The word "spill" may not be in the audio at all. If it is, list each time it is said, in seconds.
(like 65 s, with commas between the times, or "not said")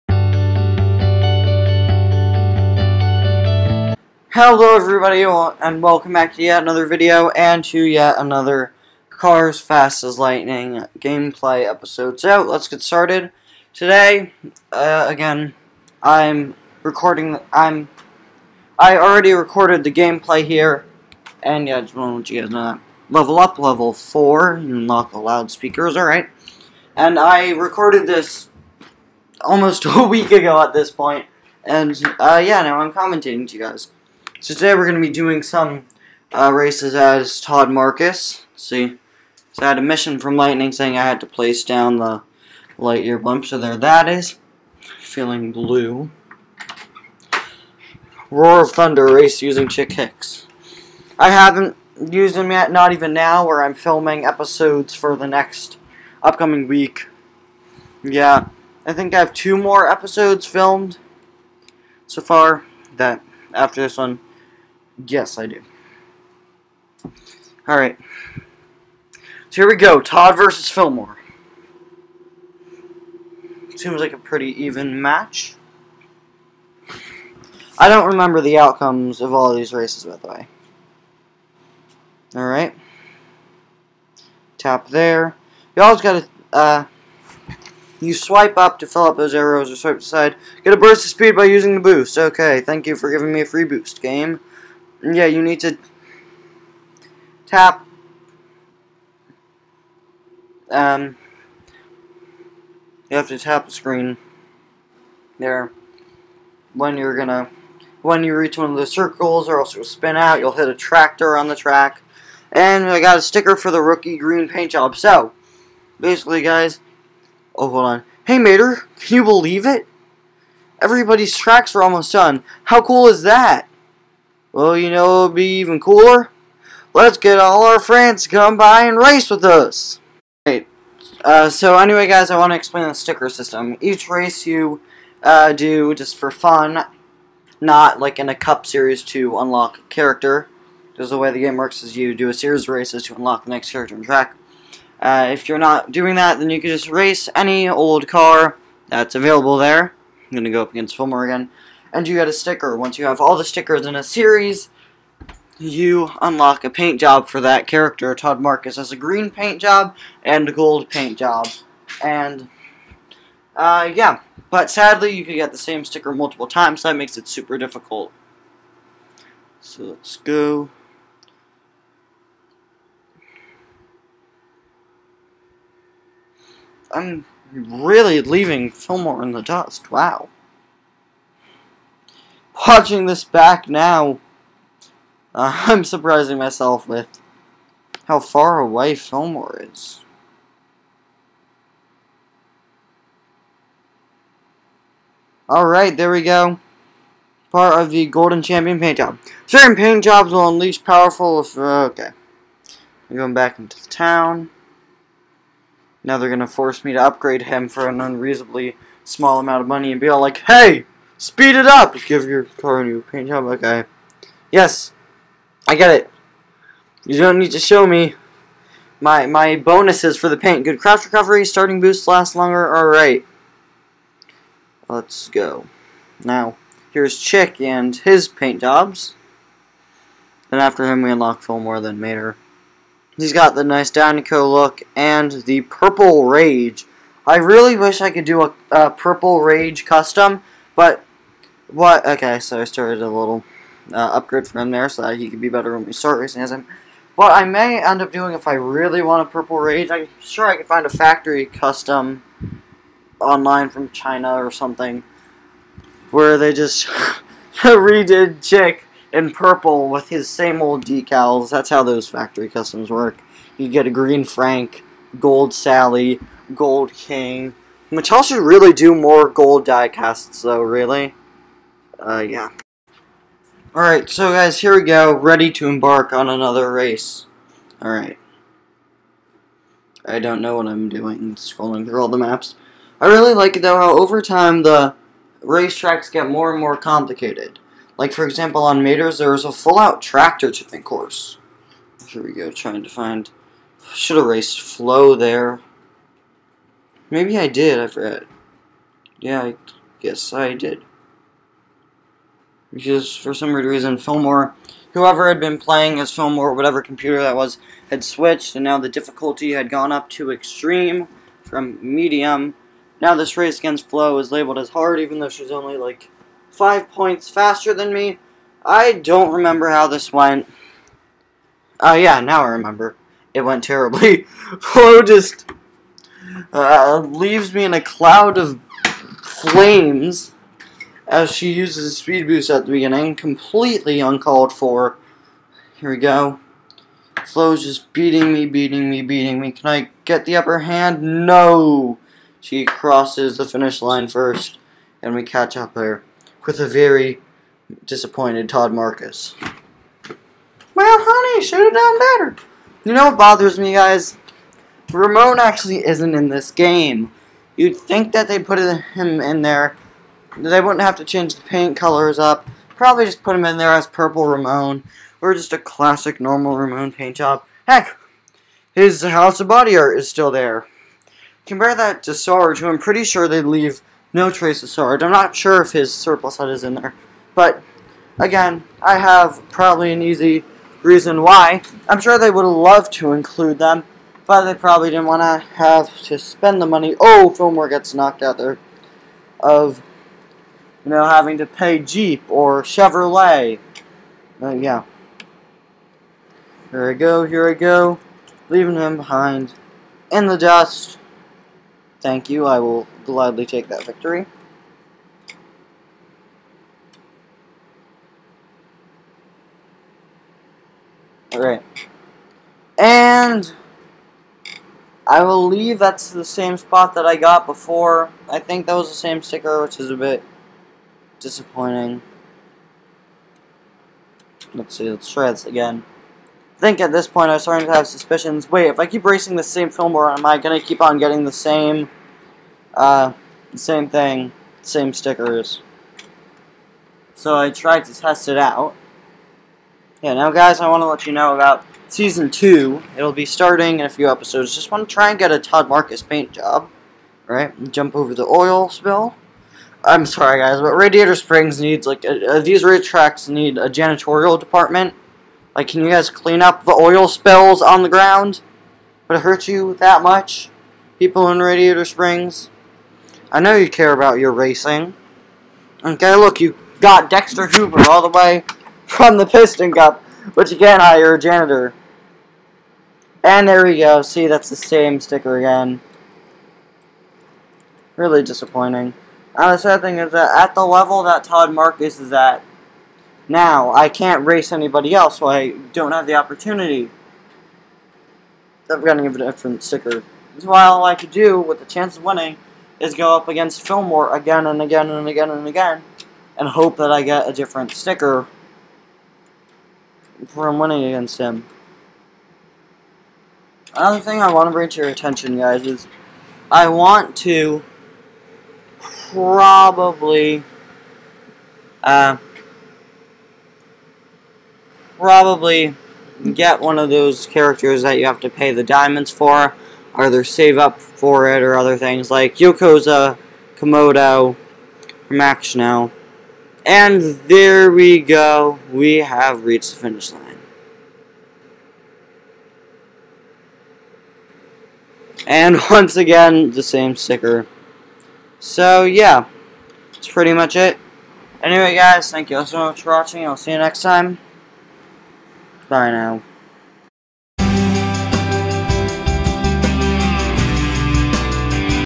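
448 s, 457 s.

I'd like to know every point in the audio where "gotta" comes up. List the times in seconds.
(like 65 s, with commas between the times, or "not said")
86 s.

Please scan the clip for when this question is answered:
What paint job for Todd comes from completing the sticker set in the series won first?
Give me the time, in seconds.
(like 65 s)
113 s.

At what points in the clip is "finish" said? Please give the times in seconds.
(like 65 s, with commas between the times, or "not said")
343 s, 529 s.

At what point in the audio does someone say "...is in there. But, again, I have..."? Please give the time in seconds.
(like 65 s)
376 s.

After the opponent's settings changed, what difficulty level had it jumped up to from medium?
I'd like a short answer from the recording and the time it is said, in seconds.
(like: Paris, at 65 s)
Extreme, at 310 s.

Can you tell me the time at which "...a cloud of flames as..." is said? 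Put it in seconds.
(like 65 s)
327 s.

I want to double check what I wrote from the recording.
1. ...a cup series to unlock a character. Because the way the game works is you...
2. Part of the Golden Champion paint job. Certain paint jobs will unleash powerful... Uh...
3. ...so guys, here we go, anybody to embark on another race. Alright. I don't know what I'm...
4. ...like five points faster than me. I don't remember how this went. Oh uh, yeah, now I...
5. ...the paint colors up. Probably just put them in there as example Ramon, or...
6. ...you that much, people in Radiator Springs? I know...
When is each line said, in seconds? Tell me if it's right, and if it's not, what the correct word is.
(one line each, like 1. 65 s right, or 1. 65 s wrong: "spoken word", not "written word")
1. 138 s right
2. 197 s right
3. 274 s wrong: "ready", not "anybody"
4. 315 s right
5. 361 s wrong: "purple", not "example"
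6. 459 s right.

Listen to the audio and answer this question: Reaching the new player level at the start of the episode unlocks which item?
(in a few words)
The loudspeakers.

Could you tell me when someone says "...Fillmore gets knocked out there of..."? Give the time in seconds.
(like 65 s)
387 s.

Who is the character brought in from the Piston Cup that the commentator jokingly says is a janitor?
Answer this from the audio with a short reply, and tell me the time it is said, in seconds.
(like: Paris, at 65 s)
Dexter Hoover, at 467 s.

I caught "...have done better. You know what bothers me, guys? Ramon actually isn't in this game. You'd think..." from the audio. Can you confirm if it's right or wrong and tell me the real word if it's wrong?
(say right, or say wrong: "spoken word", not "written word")
right.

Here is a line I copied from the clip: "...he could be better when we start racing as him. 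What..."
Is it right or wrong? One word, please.
right.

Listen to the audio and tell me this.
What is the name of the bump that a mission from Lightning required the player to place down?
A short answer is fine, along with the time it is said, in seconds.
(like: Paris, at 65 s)
Lightyear bump, at 42 s.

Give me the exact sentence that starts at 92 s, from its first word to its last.
Okay, thank you for giving me a free boost, game.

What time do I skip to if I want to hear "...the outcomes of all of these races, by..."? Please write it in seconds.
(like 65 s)
78 s.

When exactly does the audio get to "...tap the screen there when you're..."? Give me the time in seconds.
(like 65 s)
103 s.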